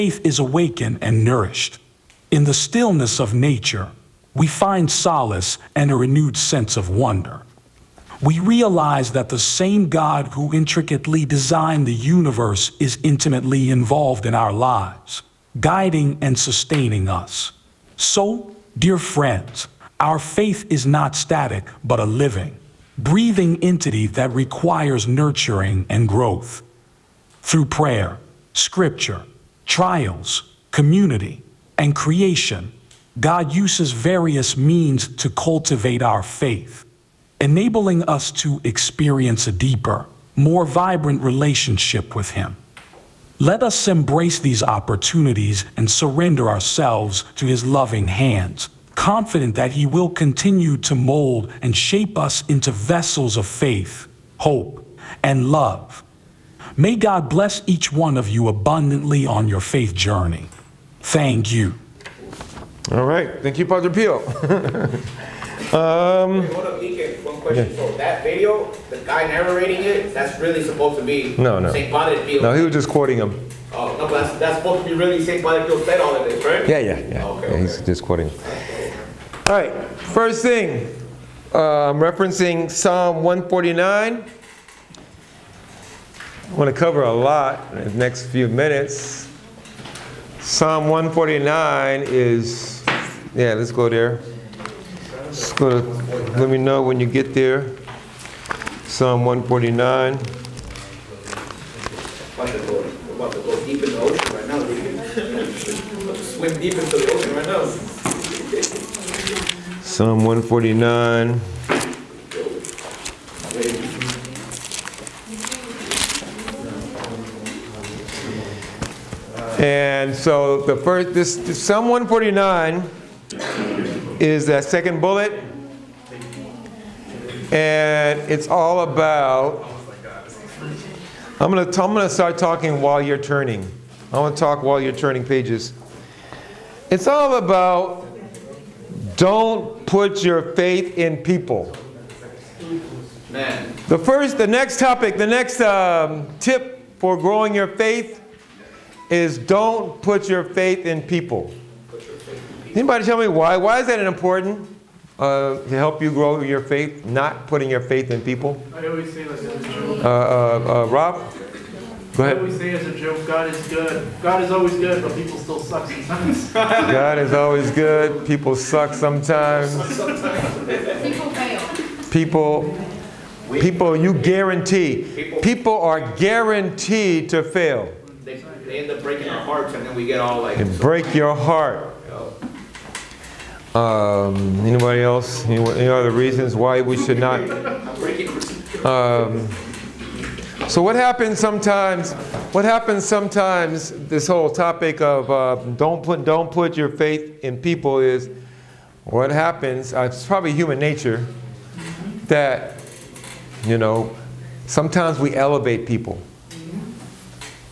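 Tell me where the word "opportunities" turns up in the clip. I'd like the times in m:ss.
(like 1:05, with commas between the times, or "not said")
0:44.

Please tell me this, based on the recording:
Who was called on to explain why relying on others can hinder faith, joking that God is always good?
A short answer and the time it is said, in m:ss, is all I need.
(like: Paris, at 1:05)
Rob, at 2:40.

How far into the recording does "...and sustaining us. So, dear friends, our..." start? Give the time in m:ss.
0:16.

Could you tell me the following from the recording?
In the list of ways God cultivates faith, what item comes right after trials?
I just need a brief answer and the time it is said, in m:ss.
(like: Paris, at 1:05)
community, at 0:30.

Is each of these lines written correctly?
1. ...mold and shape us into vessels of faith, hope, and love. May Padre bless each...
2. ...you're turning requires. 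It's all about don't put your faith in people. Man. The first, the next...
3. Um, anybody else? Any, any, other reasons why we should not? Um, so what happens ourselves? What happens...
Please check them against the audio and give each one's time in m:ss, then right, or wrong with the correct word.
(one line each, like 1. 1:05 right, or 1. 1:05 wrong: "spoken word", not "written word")
1. 0:50 wrong: "God", not "Padre"
2. 2:14 wrong: "pages", not "requires"
3. 3:03 wrong: "sometimes", not "ourselves".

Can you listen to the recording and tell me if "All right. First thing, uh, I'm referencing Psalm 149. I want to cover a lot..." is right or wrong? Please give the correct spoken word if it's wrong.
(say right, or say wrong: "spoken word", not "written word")
right.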